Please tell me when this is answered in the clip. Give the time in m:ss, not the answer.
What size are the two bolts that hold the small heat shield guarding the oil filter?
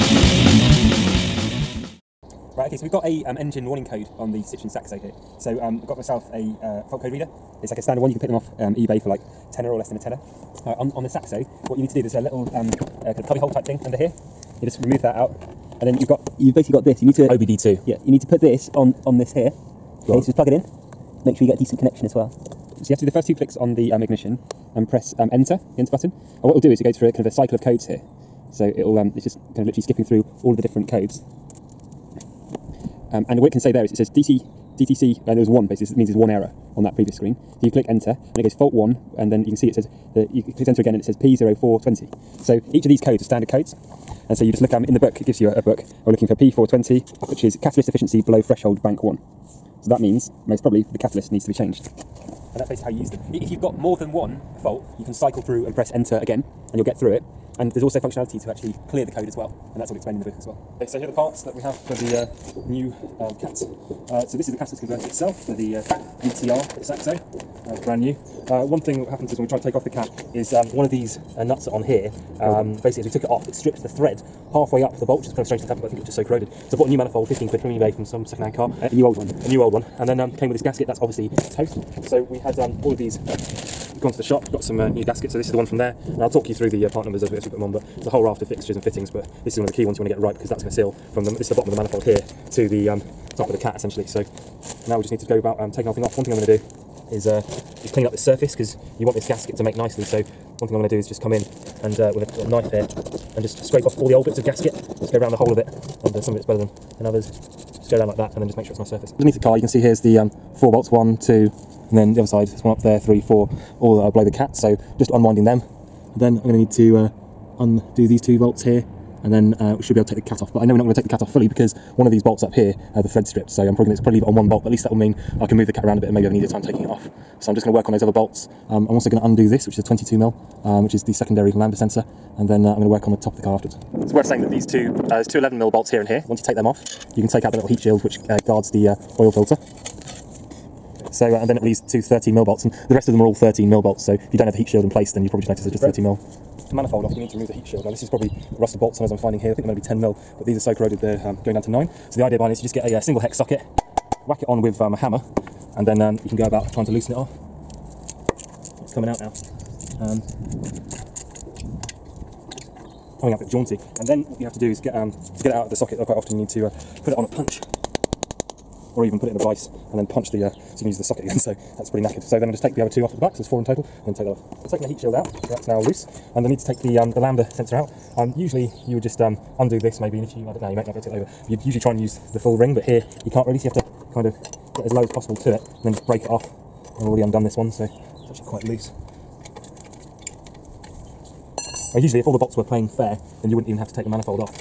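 2:15.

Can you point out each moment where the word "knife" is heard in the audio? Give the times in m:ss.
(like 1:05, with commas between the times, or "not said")
1:42.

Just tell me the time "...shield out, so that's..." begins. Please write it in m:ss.
2:54.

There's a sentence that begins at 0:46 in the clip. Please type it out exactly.
We're looking for P420, which is catalyst efficiency below threshold bank 1.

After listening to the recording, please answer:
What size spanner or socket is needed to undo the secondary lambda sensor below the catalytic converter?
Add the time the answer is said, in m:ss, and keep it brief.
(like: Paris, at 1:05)
22 mil, at 2:09.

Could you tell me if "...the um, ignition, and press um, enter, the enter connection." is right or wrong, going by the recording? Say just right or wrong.
wrong.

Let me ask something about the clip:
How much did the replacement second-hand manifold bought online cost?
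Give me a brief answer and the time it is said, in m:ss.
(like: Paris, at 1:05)
15 quid, at 1:17.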